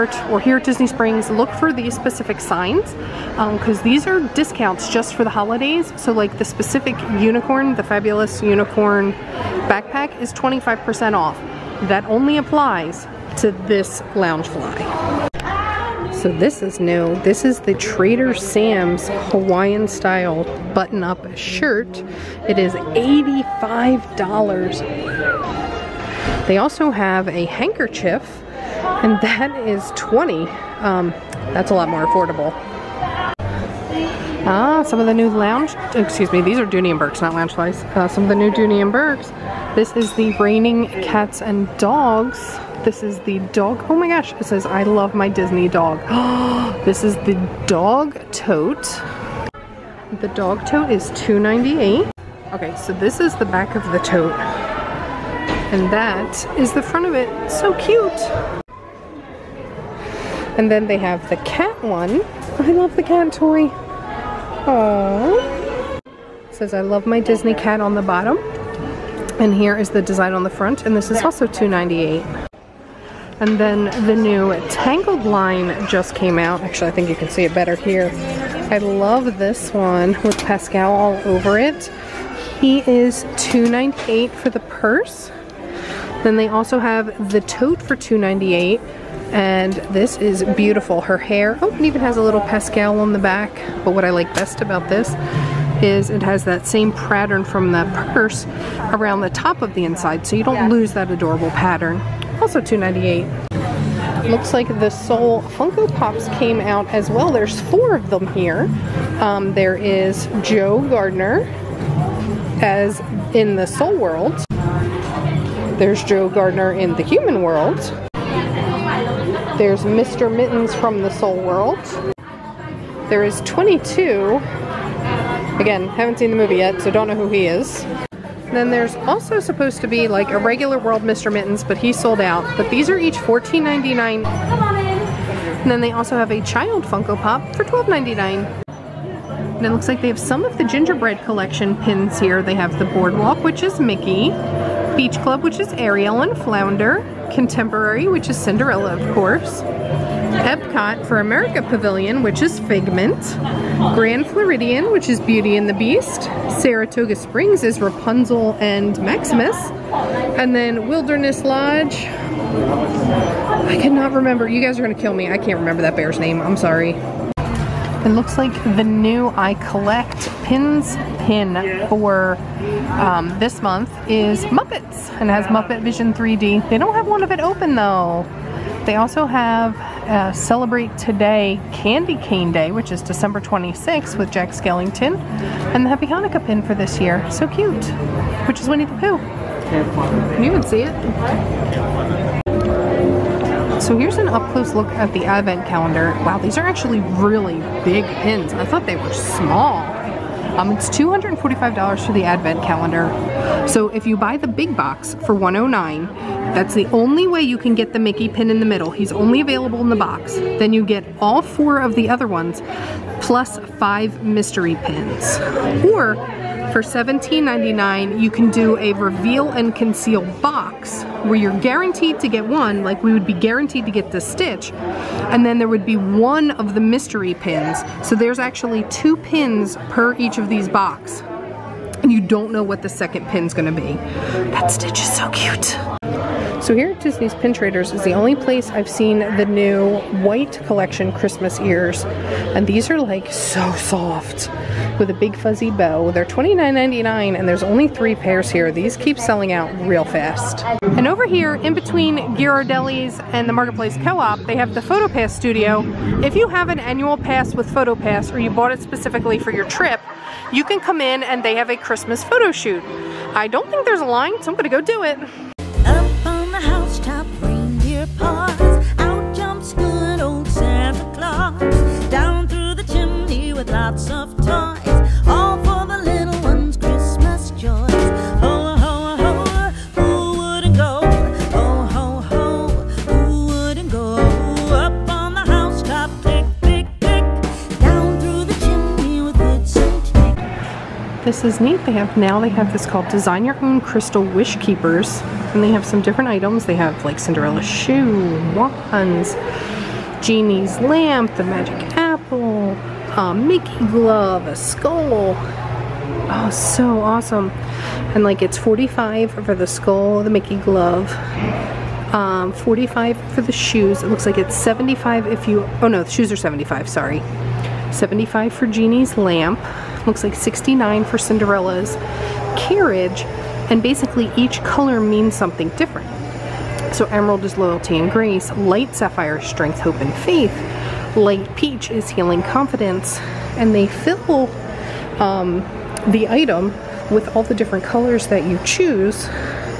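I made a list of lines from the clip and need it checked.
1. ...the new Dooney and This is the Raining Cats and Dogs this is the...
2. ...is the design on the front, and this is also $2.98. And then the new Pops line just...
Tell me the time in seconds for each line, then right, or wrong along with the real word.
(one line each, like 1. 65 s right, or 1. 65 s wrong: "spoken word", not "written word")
1. 38 s right
2. 69 s wrong: "Tangled", not "Pops".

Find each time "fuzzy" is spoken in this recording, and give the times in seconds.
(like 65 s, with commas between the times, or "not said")
245 s.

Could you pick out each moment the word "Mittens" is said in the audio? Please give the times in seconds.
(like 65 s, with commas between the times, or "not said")
120 s, 131 s.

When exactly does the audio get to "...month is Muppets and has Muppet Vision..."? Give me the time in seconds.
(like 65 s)
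173 s.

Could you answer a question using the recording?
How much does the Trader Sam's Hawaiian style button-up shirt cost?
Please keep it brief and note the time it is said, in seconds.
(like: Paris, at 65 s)
$85, at 22 s.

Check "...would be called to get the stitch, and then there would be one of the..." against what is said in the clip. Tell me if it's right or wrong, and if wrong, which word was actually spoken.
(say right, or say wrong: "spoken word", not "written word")
wrong: "guaranteed", not "called".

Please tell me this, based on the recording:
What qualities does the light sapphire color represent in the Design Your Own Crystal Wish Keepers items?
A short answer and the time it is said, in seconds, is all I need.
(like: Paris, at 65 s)
Strength, hope, and faith, at 329 s.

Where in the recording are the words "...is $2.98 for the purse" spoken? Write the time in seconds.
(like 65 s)
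82 s.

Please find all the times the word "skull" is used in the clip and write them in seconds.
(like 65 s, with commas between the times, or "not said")
304 s, 309 s.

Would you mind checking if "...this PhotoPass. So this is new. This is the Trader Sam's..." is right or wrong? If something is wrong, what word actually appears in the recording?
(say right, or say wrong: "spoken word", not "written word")
wrong: "Loungefly", not "PhotoPass".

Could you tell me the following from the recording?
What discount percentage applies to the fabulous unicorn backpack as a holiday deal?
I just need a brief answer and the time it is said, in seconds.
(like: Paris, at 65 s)
25%, at 10 s.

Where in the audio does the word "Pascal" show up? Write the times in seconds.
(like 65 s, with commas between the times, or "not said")
80 s, 92 s.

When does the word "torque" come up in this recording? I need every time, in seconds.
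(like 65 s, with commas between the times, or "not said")
not said.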